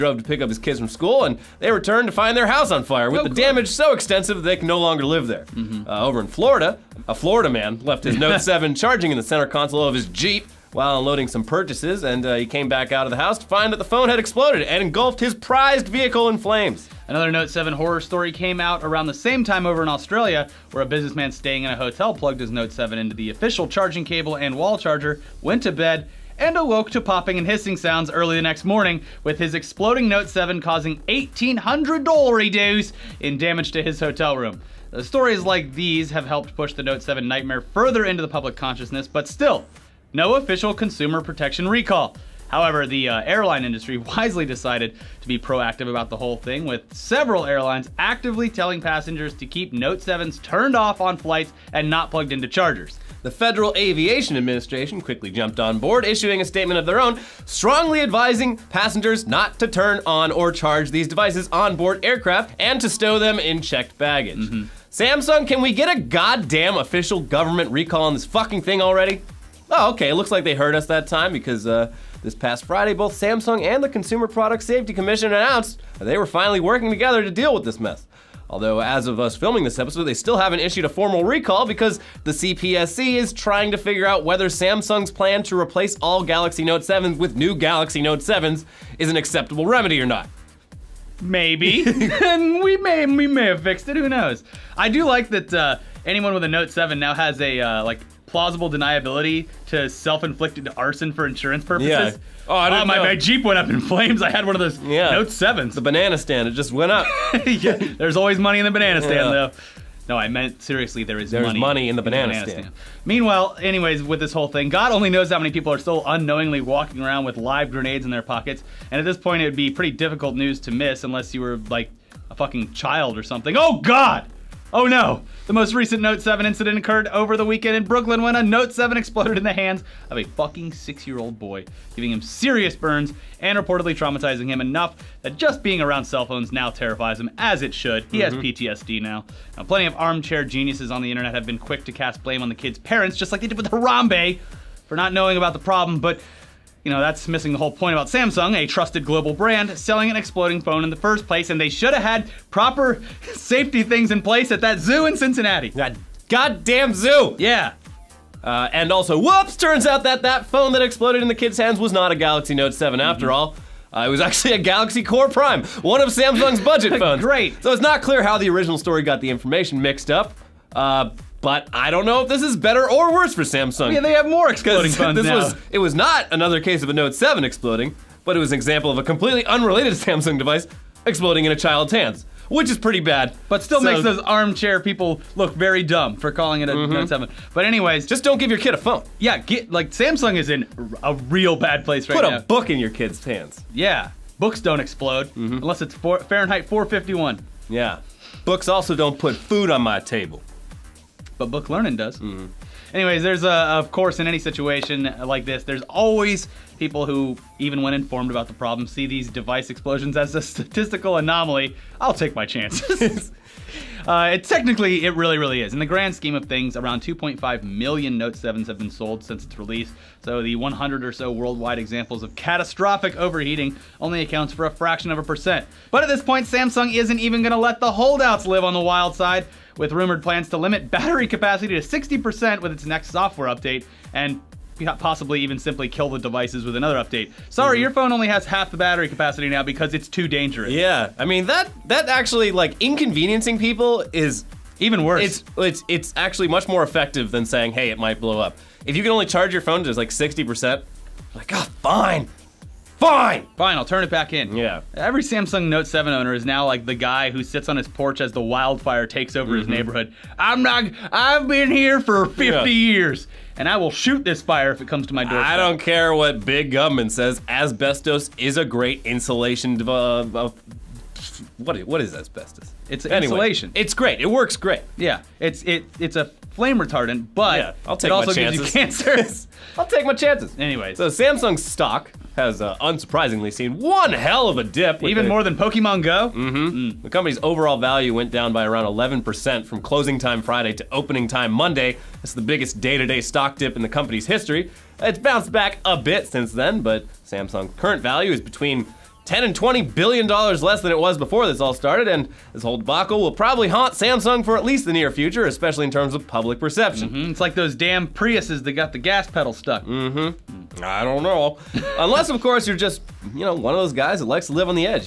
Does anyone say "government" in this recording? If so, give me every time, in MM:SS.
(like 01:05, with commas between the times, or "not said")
01:07, 04:26.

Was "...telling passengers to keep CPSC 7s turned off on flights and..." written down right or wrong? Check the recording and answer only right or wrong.
wrong.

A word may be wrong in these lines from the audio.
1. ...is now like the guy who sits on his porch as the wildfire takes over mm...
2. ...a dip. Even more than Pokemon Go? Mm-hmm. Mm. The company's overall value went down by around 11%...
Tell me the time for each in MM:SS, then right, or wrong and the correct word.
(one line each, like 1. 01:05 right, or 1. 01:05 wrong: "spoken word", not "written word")
1. 04:16 right
2. 04:44 right.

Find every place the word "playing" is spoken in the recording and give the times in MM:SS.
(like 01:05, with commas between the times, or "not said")
not said.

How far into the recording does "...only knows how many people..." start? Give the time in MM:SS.
01:54.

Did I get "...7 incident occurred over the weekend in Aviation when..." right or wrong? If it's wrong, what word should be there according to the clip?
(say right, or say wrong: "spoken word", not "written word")
wrong: "Brooklyn", not "Aviation".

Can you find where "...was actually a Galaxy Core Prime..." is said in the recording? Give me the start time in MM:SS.
02:44.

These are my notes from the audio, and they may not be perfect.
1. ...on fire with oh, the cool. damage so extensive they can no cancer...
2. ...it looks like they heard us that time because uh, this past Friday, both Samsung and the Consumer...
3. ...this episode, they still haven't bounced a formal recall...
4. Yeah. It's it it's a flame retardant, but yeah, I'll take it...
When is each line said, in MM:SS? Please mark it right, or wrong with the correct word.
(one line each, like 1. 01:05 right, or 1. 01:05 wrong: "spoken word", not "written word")
1. 00:02 wrong: "longer", not "cancer"
2. 01:10 right
3. 01:19 wrong: "issued", not "bounced"
4. 04:34 right.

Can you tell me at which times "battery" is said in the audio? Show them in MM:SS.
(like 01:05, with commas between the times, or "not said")
03:50, 03:58.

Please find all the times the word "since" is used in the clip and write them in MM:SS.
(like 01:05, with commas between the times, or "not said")
03:39, 04:56.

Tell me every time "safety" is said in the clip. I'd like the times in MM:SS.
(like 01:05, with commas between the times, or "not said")
01:14, 02:33.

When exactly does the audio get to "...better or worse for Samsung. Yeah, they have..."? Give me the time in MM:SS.
02:52.